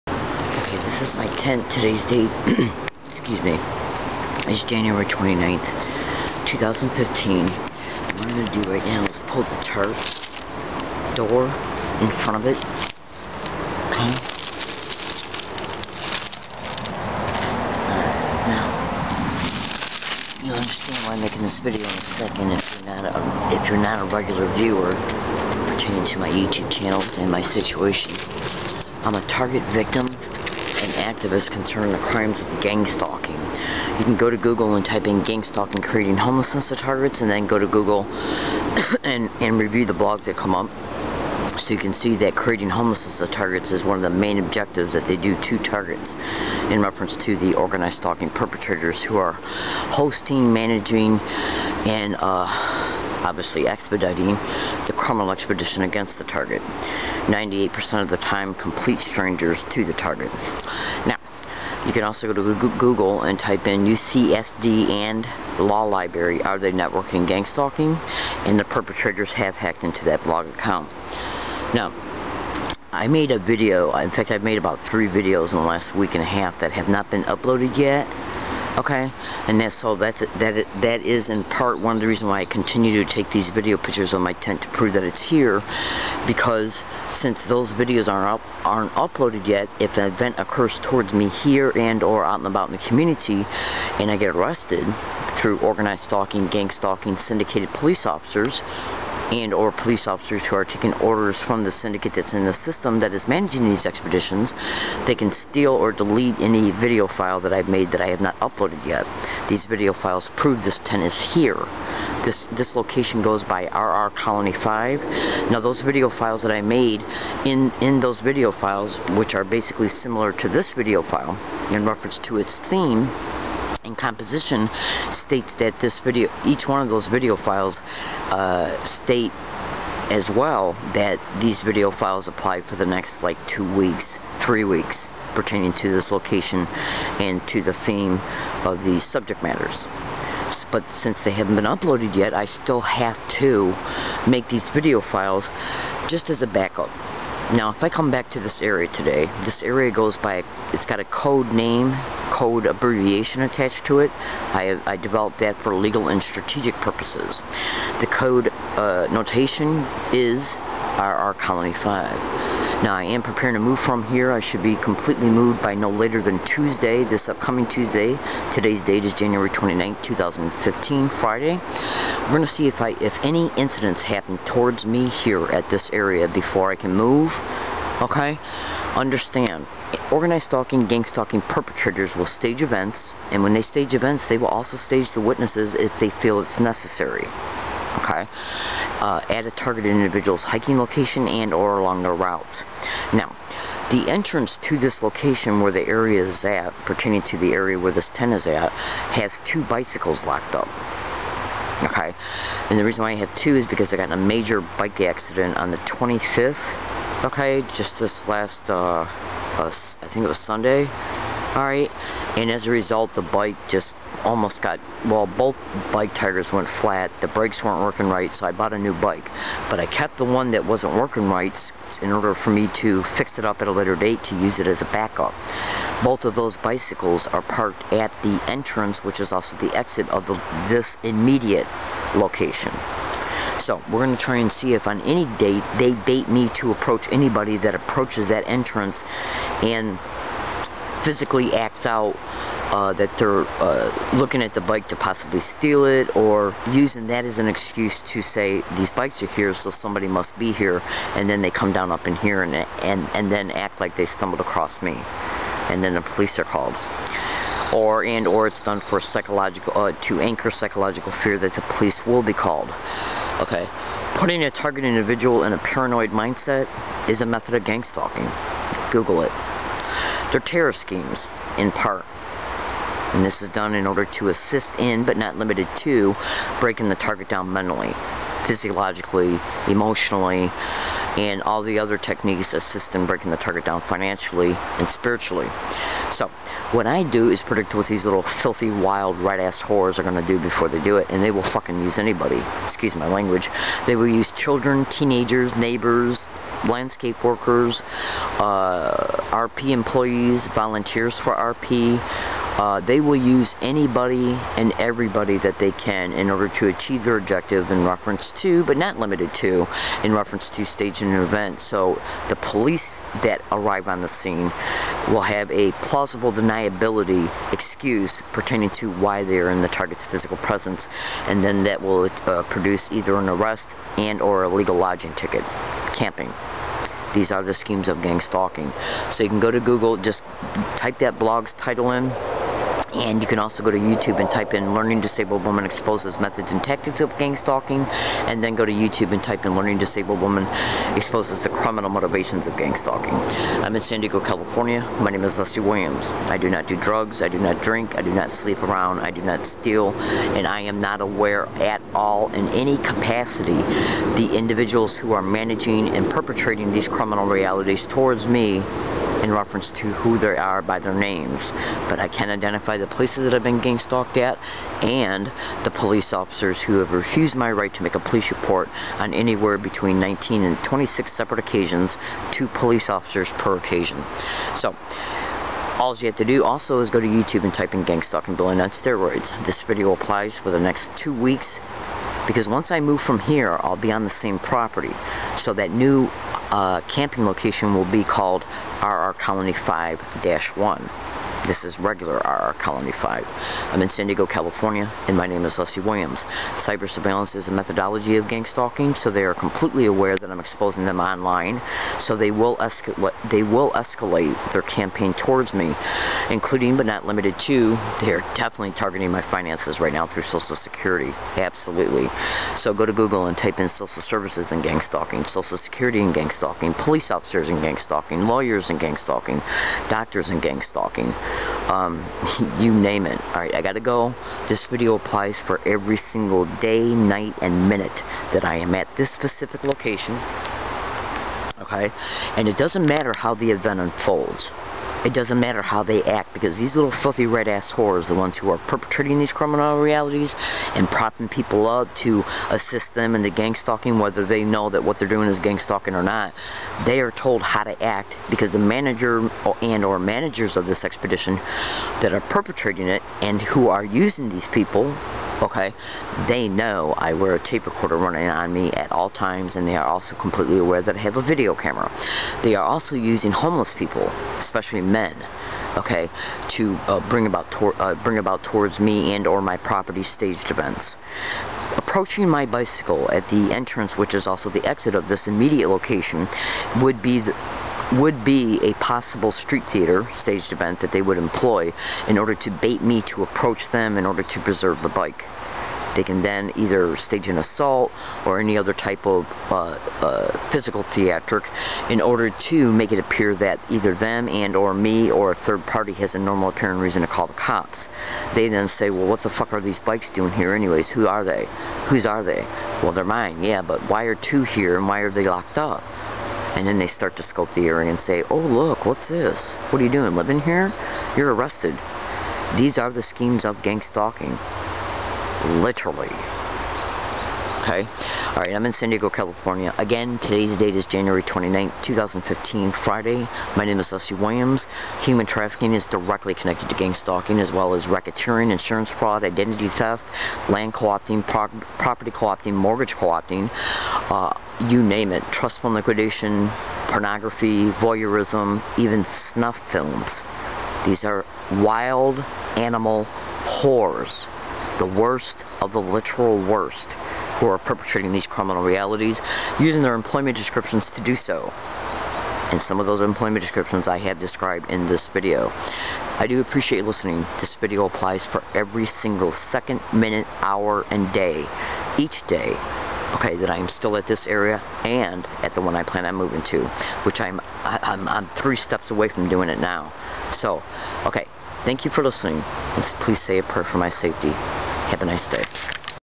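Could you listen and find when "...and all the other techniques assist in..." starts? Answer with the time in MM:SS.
04:41.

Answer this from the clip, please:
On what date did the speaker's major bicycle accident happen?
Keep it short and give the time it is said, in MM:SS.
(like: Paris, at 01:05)
the 25th, at 03:25.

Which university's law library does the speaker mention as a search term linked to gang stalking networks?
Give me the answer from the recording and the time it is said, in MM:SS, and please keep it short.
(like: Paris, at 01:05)
UCSD, at 01:03.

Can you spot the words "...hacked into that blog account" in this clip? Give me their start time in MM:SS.
01:09.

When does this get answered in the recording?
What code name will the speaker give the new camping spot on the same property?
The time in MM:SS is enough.
06:28.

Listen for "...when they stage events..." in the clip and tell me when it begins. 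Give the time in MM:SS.
03:03.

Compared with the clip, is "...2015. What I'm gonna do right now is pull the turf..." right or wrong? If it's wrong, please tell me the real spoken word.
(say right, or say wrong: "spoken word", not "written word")
right.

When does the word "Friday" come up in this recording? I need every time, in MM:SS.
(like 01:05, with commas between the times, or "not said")
02:51, 08:42.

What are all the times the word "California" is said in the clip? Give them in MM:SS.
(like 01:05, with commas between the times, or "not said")
05:44, 06:34, 08:39.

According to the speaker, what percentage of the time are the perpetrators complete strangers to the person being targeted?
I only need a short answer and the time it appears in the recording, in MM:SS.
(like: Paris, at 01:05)
98%, at 00:57.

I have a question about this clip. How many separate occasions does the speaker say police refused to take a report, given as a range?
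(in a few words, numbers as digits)
19 to 26.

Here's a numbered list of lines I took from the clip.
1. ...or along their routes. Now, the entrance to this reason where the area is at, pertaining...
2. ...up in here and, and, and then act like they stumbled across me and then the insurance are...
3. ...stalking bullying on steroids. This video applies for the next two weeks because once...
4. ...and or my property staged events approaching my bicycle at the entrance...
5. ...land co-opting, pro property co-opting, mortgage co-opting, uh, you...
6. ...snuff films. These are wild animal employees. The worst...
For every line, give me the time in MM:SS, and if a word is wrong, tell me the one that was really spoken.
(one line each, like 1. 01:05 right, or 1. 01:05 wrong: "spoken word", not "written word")
1. 03:11 wrong: "location", not "reason"
2. 04:11 wrong: "police", not "insurance"
3. 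06:18 right
4. 07:49 right
5. 08:50 right
6. 08:59 wrong: "whores", not "employees".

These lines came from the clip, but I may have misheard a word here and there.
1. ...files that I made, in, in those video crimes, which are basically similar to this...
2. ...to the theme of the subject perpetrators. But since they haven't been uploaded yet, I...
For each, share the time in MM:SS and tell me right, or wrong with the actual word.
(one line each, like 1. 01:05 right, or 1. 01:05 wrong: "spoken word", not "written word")
1. 01:56 wrong: "files", not "crimes"
2. 02:17 wrong: "matters", not "perpetrators".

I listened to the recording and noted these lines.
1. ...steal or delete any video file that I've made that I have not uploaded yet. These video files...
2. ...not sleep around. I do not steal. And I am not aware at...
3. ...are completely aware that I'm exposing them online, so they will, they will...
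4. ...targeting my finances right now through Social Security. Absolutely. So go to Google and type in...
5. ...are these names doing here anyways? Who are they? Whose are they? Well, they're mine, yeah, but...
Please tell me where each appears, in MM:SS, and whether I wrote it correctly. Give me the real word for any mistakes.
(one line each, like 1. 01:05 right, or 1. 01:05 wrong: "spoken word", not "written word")
1. 01:45 right
2. 05:48 right
3. 06:39 right
4. 06:48 right
5. 08:19 wrong: "bikes", not "names".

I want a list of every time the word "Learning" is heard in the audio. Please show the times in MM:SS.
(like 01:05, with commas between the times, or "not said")
05:34, 05:39.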